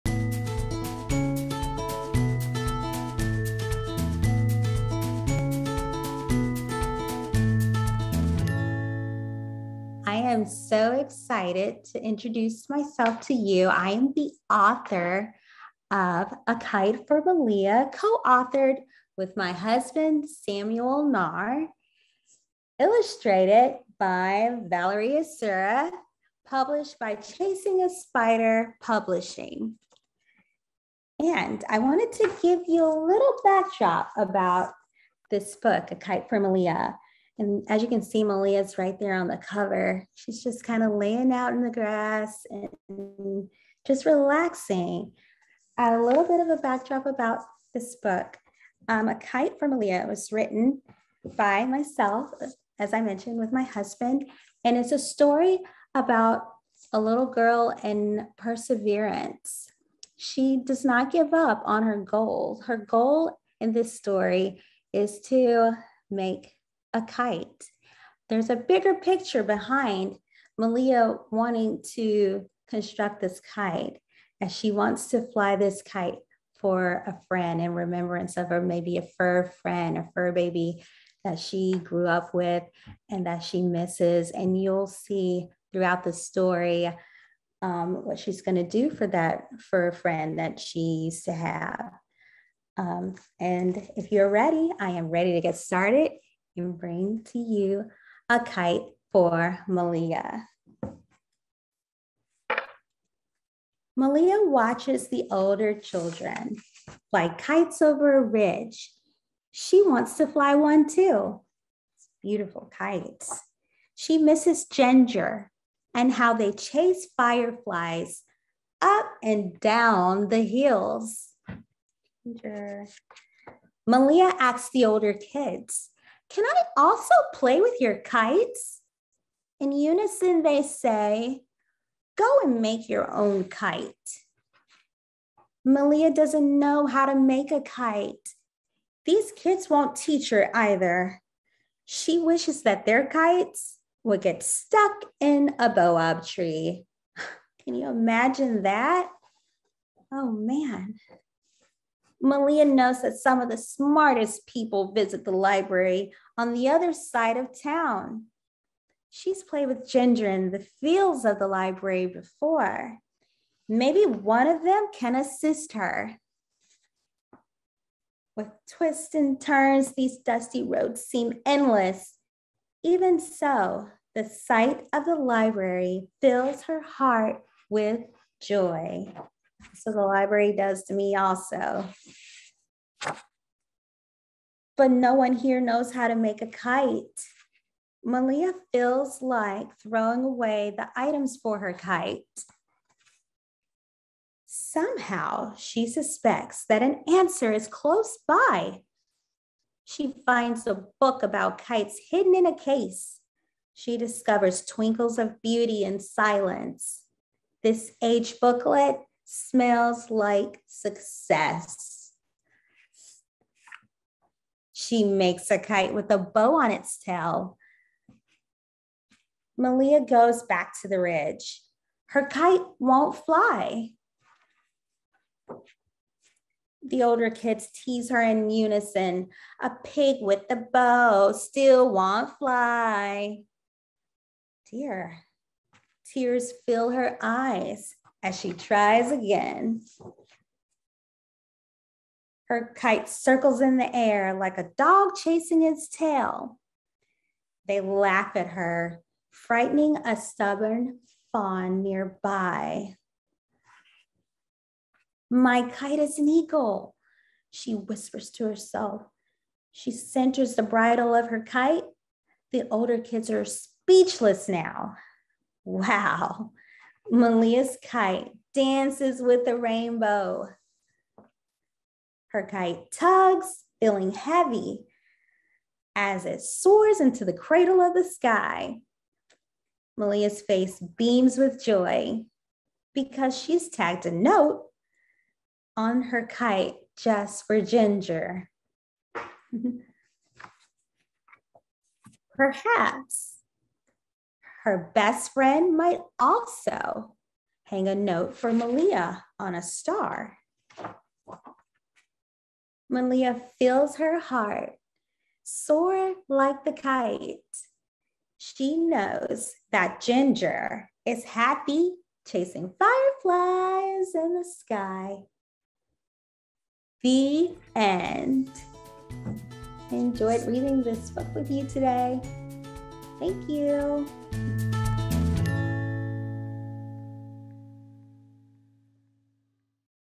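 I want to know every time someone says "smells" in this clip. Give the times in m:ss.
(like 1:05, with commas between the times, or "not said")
3:29.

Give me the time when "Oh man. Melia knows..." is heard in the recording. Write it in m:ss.
2:30.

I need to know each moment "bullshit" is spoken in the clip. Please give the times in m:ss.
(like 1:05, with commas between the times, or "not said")
not said.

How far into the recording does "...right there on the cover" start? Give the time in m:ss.
0:38.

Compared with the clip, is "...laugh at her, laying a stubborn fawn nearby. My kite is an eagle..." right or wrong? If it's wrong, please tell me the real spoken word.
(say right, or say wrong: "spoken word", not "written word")
wrong: "frightening", not "laying".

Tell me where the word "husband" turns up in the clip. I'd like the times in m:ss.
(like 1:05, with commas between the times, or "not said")
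0:19, 0:53.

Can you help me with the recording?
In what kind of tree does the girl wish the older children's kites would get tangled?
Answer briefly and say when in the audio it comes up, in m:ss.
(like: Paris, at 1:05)
boab tree, at 2:25.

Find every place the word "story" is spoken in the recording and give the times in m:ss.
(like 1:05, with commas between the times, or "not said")
0:54, 1:03, 1:26.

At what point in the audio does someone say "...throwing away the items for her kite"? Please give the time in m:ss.
3:09.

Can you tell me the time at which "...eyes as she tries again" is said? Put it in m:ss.
3:57.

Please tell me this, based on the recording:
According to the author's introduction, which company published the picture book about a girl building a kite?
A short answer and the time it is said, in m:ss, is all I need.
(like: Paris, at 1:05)
Chasing a Spider Publishing, at 0:27.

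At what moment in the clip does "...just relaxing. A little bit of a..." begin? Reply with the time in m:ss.
0:43.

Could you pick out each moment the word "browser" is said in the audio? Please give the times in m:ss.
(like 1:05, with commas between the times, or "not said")
not said.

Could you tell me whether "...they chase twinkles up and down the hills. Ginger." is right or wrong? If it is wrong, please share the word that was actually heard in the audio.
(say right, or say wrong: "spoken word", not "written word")
wrong: "fireflies", not "twinkles".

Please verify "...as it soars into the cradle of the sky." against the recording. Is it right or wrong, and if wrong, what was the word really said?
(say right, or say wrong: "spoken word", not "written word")
right.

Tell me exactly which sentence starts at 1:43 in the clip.
Melia watches the older children fly kites over a ridge.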